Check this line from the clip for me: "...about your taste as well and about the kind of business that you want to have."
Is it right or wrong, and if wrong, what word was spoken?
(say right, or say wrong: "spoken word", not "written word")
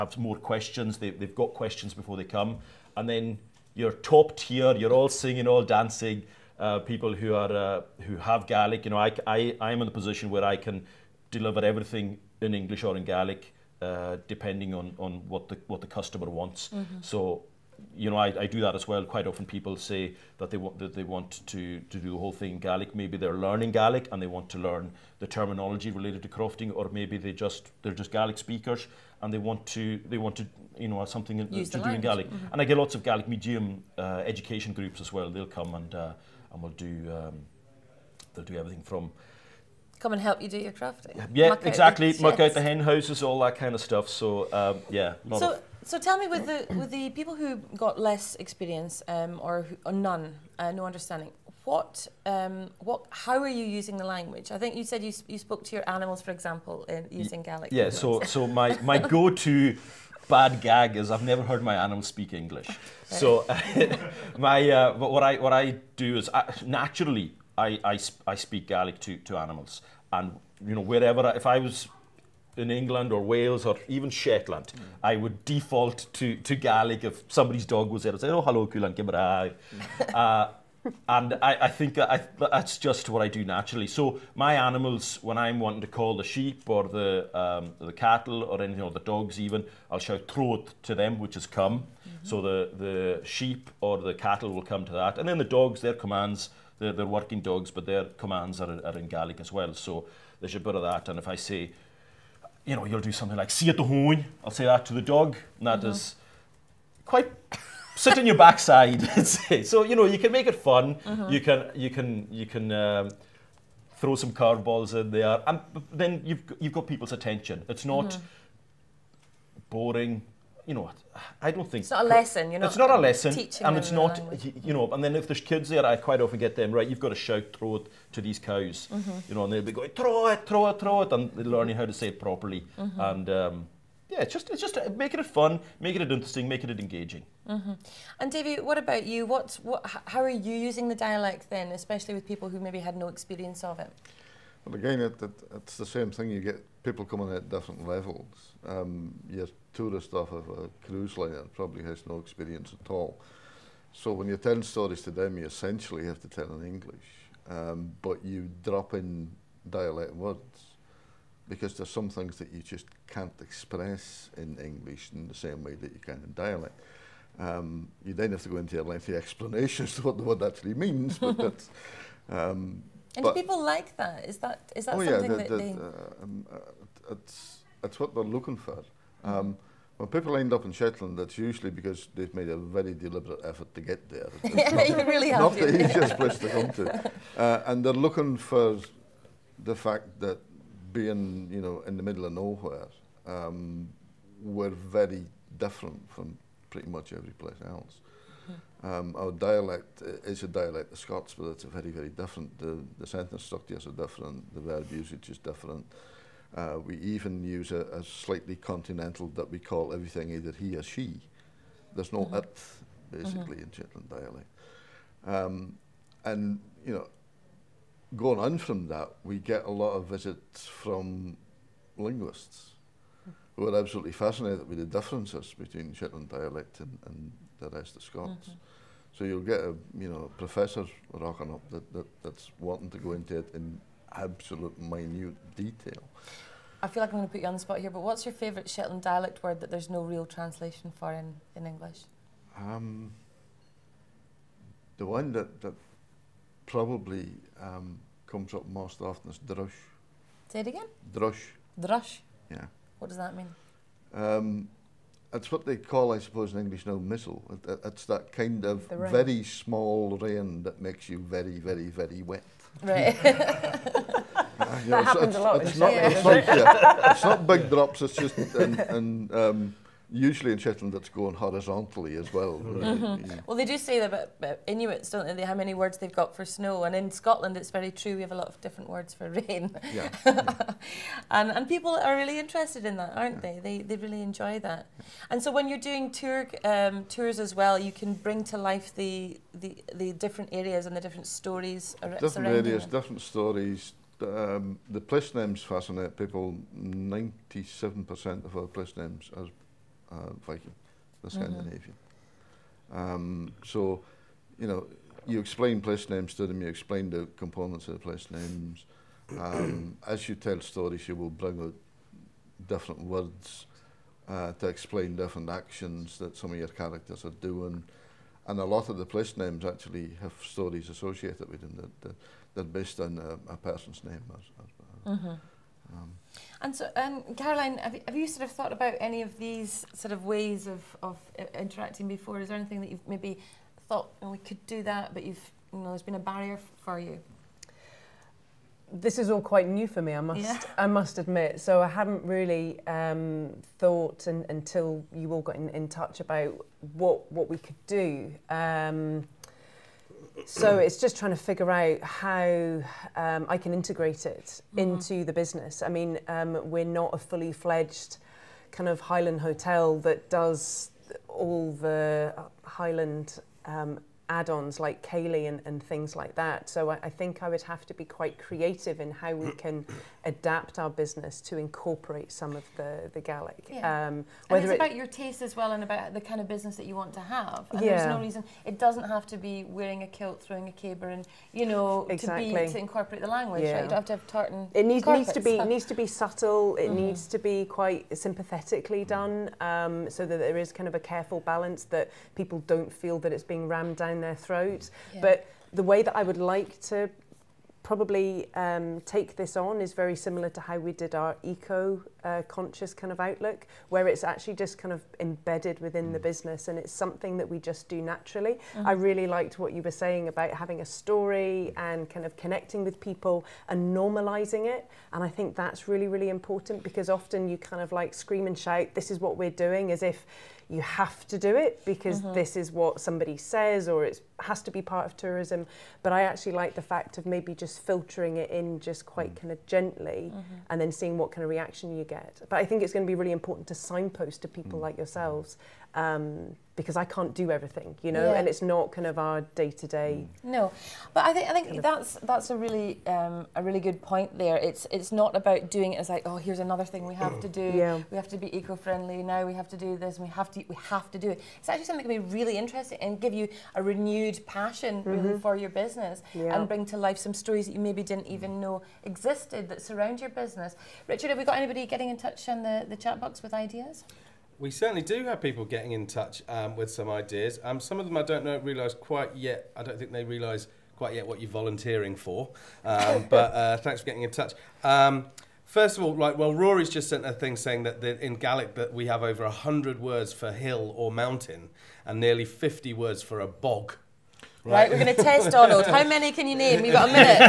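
right.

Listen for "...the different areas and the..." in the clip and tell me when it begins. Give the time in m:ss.
4:49.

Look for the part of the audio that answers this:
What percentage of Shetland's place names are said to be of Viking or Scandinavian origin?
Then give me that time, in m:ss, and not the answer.
4:56.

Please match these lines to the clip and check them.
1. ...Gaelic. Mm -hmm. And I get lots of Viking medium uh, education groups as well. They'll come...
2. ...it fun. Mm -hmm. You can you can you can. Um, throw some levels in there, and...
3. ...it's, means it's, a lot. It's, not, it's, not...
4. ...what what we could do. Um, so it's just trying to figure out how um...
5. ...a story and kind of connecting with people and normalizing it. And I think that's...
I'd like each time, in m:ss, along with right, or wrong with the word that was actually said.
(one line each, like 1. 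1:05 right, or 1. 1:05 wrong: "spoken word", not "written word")
1. 0:32 wrong: "Gaelic", not "Viking"
2. 1:50 wrong: "curveballs", not "levels"
3. 4:24 wrong: "happens", not "means"
4. 5:46 right
5. 6:50 right.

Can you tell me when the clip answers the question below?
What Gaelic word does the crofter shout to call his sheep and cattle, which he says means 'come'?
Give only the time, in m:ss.
1:30.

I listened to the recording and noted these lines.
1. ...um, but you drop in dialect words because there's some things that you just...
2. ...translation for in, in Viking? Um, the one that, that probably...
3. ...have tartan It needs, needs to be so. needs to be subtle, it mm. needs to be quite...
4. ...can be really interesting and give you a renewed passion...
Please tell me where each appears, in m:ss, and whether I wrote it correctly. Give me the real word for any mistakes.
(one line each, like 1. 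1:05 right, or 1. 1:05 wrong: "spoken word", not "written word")
1. 2:37 right
2. 4:00 wrong: "English", not "Viking"
3. 6:24 right
4. 7:32 right.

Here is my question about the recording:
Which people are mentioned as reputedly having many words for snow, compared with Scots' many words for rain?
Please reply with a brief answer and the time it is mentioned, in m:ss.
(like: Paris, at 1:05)
Inuits, at 4:34.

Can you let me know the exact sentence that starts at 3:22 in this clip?
The, the sentence structures are different, the verb usage is different.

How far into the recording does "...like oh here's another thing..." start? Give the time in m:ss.
7:26.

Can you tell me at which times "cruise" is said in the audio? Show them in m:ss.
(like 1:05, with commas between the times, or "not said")
2:30.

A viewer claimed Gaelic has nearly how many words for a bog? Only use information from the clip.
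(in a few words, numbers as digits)
50.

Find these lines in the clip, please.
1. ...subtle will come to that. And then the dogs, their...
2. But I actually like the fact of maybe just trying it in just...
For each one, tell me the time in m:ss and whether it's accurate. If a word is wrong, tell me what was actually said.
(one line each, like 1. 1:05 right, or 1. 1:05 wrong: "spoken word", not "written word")
1. 1:34 wrong: "cattle", not "subtle"
2. 7:06 wrong: "filtering", not "trying".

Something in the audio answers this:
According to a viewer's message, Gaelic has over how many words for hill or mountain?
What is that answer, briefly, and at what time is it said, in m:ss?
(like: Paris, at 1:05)
100, at 7:59.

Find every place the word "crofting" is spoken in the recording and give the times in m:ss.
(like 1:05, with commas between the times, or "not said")
0:26, 0:40.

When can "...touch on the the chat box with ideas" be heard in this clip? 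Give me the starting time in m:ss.
7:42.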